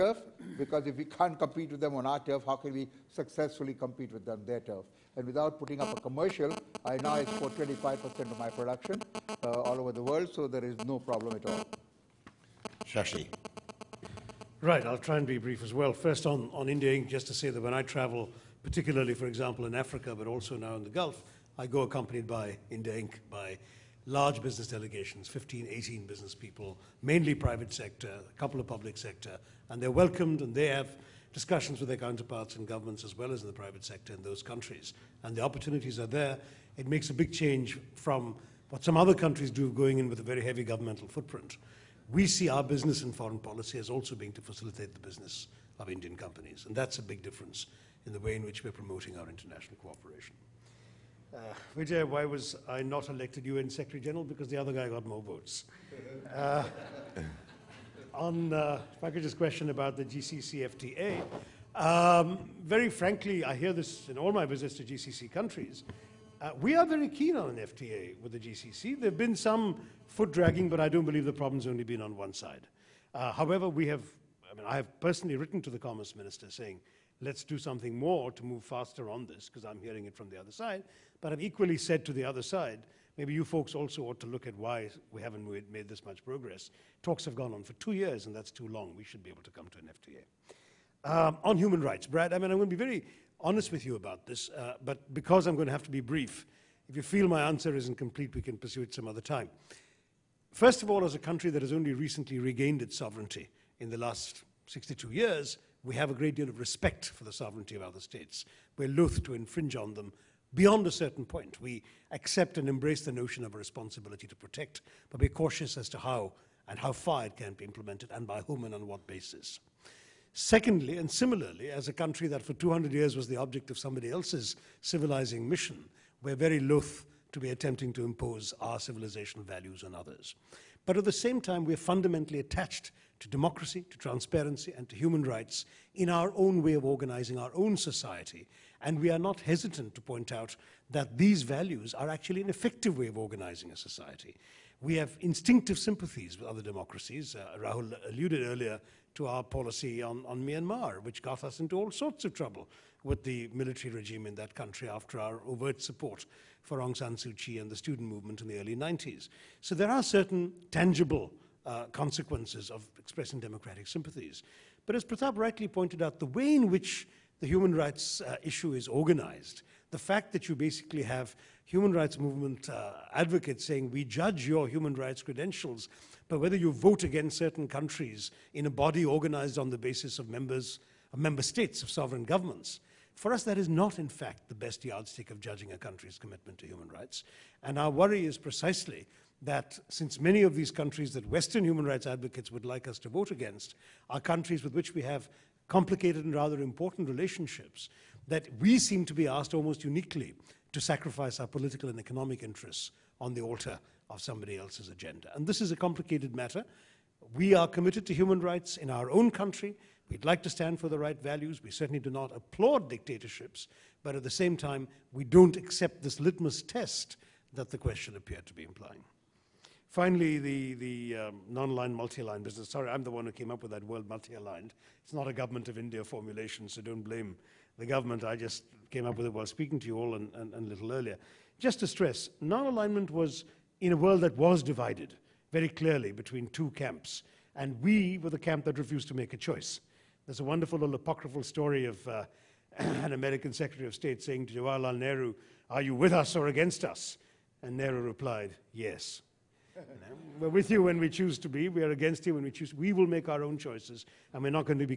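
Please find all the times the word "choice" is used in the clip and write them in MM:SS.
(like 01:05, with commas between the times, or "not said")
03:59, 04:13.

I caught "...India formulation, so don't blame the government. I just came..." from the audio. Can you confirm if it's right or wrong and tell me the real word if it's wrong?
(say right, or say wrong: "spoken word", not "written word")
right.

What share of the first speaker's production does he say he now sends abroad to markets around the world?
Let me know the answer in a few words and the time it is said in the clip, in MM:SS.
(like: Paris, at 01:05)
25%, at 00:07.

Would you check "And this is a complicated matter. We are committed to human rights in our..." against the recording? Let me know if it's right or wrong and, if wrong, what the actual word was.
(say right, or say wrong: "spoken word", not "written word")
right.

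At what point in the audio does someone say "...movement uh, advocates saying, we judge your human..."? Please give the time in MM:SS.
02:52.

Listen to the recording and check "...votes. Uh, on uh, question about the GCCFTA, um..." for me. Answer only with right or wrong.
right.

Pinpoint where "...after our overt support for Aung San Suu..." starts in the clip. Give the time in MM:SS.
02:34.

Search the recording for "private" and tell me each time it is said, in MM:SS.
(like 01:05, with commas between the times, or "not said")
00:27, 00:33.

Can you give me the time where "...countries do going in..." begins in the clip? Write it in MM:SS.
00:39.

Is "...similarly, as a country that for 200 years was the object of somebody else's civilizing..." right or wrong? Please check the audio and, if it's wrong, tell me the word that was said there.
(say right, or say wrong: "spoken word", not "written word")
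right.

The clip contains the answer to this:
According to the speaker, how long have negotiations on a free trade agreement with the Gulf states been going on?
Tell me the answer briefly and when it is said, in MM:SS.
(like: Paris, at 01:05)
Two years, at 01:27.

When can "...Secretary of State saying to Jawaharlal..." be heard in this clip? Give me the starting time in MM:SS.
04:03.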